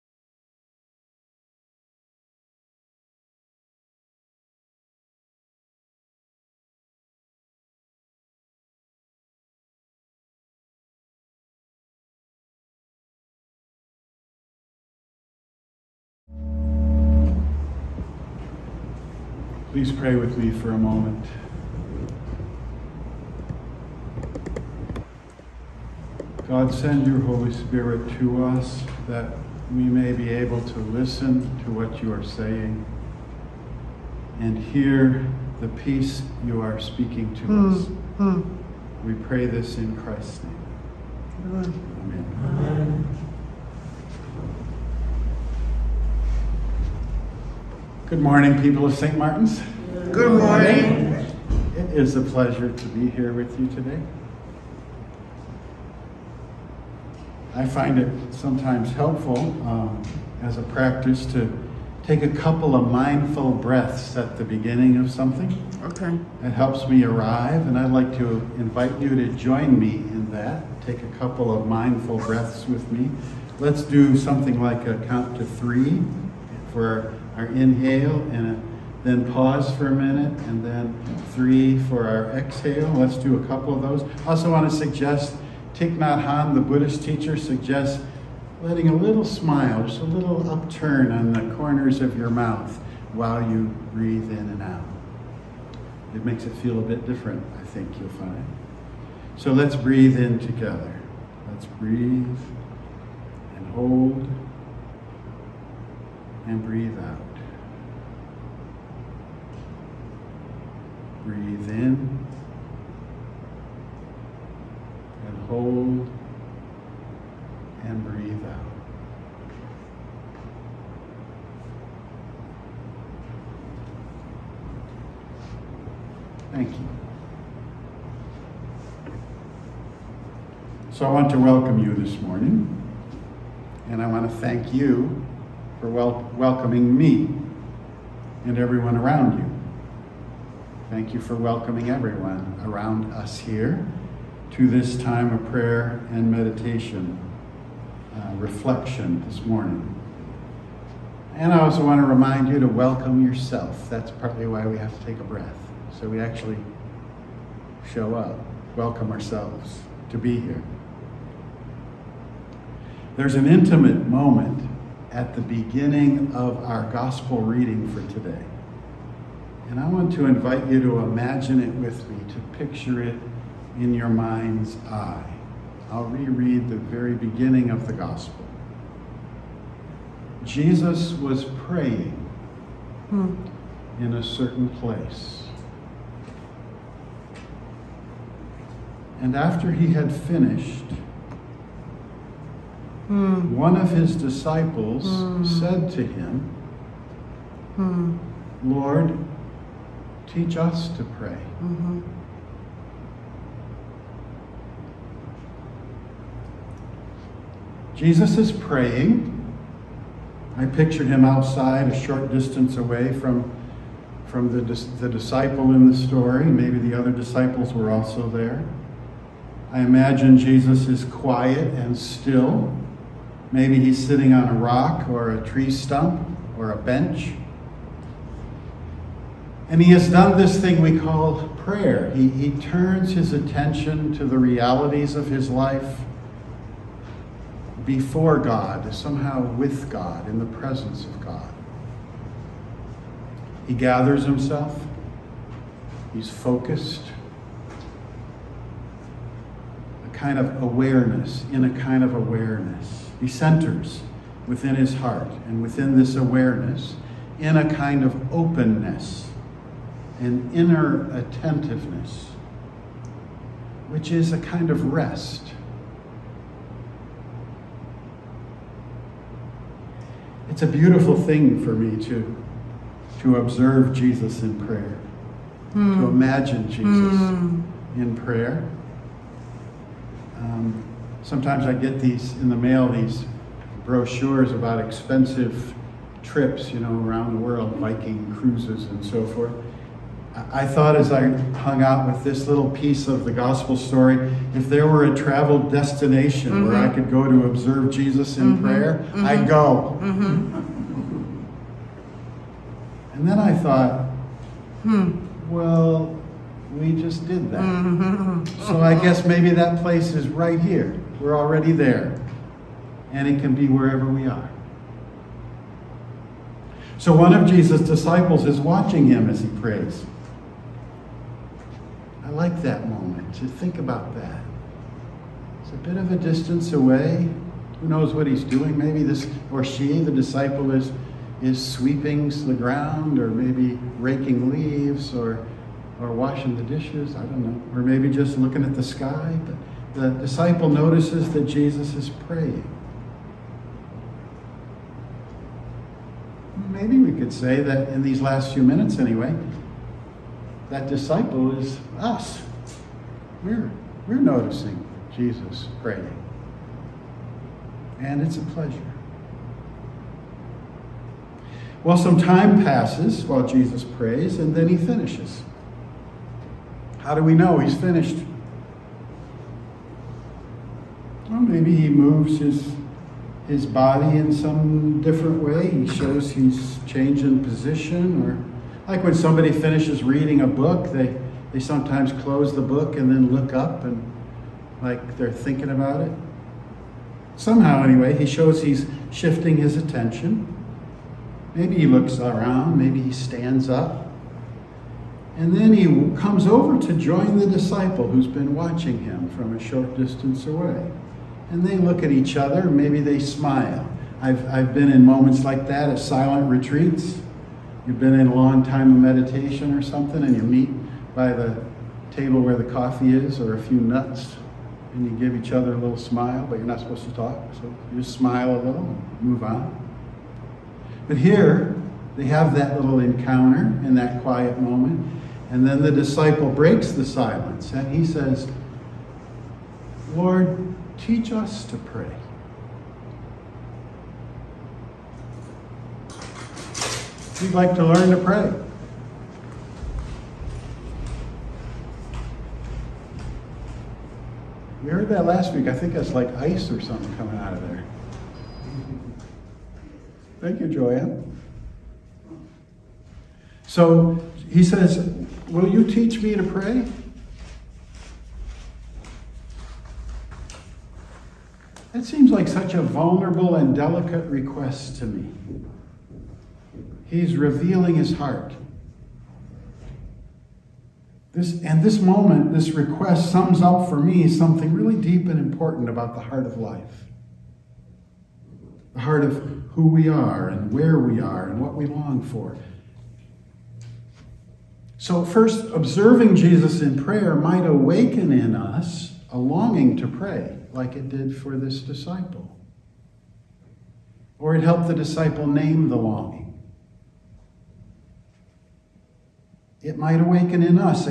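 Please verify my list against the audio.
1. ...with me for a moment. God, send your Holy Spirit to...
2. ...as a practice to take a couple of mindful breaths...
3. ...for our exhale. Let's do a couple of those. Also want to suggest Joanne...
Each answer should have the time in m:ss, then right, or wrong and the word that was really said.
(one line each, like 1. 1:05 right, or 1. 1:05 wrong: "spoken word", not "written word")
1. 0:20 right
2. 1:00 right
3. 1:21 wrong: "Thich", not "Joanne".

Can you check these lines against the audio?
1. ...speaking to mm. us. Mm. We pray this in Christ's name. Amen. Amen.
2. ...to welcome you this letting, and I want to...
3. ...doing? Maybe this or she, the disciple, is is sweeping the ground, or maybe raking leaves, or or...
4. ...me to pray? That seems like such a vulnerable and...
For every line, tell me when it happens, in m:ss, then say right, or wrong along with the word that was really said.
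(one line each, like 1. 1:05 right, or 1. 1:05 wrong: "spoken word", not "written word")
1. 0:36 right
2. 2:11 wrong: "morning", not "letting"
3. 5:28 right
4. 7:36 right.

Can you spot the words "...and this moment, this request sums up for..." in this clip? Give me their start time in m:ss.
7:51.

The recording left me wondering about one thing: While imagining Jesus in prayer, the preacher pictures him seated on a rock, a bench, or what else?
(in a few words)
a tree stump.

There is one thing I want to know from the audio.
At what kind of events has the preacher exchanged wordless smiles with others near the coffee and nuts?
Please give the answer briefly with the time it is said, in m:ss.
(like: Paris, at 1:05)
silent retreats, at 6:45.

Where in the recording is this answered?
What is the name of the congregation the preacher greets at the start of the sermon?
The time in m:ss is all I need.
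0:48.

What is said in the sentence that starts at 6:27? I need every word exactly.
Somehow, anyway, he shows he's shifting his attention.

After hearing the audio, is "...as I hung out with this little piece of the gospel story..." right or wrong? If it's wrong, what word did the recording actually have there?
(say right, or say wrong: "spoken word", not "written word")
right.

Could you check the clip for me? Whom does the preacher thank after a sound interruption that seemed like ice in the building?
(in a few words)
Joanne.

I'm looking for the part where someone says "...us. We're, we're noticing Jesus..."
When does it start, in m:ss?
5:51.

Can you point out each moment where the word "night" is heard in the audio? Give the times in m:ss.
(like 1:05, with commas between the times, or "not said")
not said.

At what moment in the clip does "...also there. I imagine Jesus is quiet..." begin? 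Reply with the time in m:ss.
3:37.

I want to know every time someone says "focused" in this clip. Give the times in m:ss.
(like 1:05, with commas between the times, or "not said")
4:06.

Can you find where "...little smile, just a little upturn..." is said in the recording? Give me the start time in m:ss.
1:28.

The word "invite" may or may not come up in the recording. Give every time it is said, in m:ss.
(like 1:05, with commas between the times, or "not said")
1:08, 2:50.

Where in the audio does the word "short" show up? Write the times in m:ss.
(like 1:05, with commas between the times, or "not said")
3:31, 6:39.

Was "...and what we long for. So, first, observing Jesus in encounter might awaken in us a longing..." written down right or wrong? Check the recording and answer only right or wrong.
wrong.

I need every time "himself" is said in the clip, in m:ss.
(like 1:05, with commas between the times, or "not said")
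4:04.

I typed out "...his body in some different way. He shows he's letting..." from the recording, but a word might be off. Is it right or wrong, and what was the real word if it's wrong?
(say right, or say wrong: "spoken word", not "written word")
wrong: "changing", not "letting".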